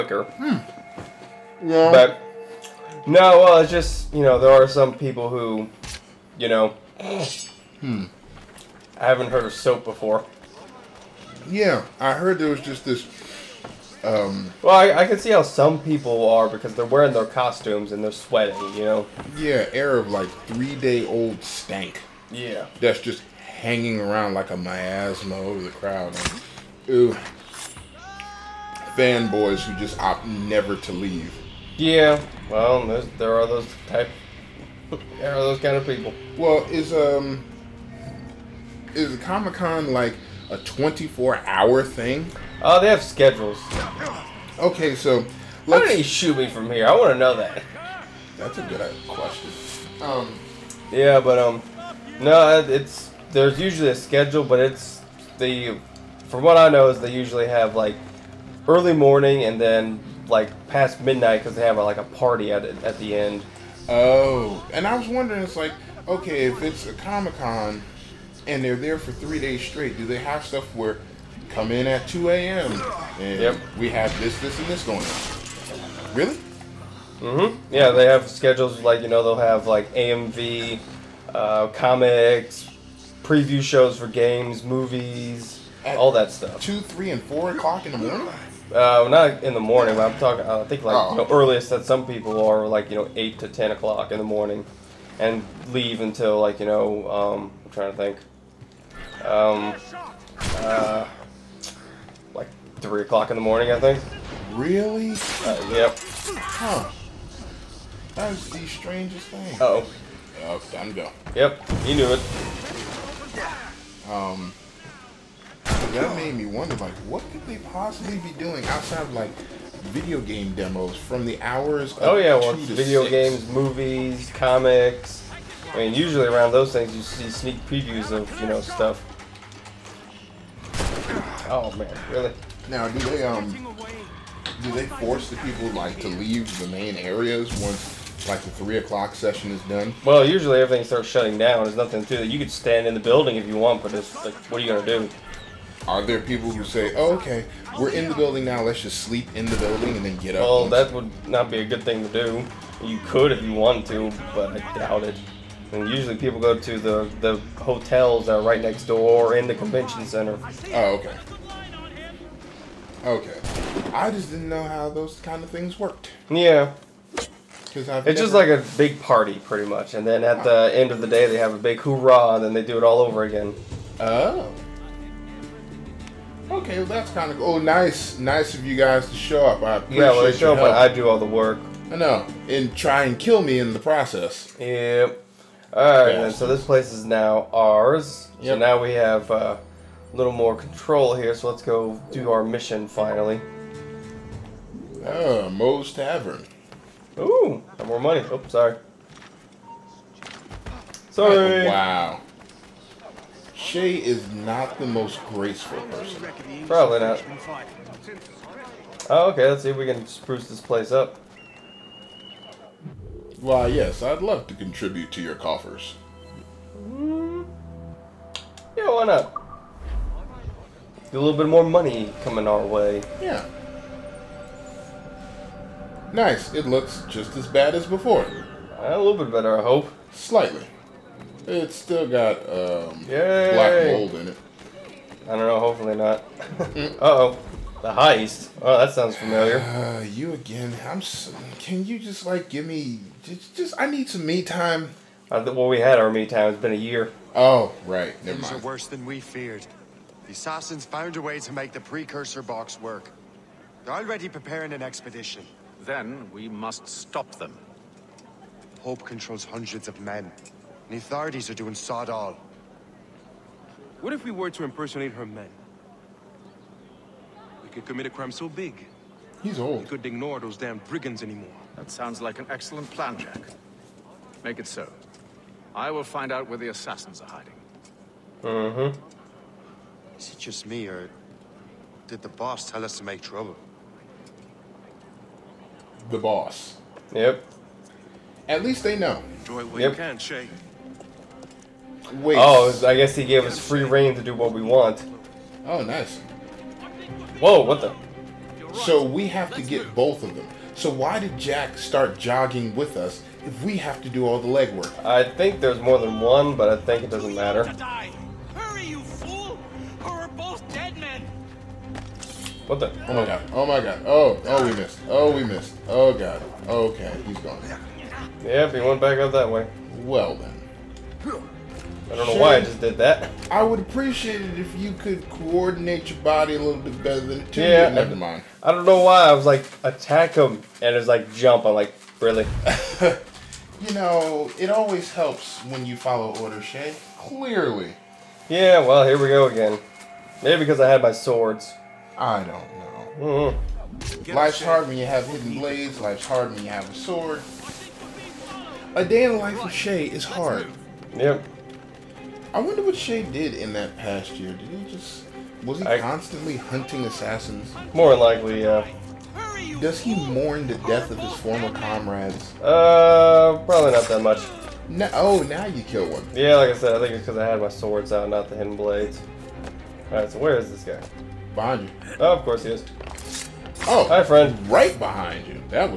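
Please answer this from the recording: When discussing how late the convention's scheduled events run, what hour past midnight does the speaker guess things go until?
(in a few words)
3 a.m.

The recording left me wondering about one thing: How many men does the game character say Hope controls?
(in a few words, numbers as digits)
Hundreds.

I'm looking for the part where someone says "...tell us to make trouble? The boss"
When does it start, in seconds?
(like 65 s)
282 s.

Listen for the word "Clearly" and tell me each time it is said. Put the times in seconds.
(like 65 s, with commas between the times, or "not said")
337 s.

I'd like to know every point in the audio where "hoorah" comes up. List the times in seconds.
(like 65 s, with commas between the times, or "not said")
171 s.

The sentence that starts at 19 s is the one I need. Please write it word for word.
Yeah, air of like three day old stank.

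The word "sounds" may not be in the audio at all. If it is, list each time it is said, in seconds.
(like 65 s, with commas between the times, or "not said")
238 s, 271 s.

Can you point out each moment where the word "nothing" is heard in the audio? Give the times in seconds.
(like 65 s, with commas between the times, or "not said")
141 s.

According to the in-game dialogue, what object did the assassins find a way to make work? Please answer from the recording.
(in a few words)
The precursor box.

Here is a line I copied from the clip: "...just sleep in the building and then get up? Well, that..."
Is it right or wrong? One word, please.
right.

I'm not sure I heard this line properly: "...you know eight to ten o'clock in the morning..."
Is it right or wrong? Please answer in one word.
right.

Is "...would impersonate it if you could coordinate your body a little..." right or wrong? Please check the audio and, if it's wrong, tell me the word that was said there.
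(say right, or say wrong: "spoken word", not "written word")
wrong: "appreciate", not "impersonate".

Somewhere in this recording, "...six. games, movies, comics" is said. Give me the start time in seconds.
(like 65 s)
123 s.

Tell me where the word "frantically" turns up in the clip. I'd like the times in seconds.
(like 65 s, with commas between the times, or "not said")
not said.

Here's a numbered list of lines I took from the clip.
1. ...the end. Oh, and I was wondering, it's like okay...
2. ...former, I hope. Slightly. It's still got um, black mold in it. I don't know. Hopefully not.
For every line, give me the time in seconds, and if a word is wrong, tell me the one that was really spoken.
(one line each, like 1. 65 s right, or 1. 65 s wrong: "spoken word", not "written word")
1. 62 s right
2. 229 s wrong: "better", not "former".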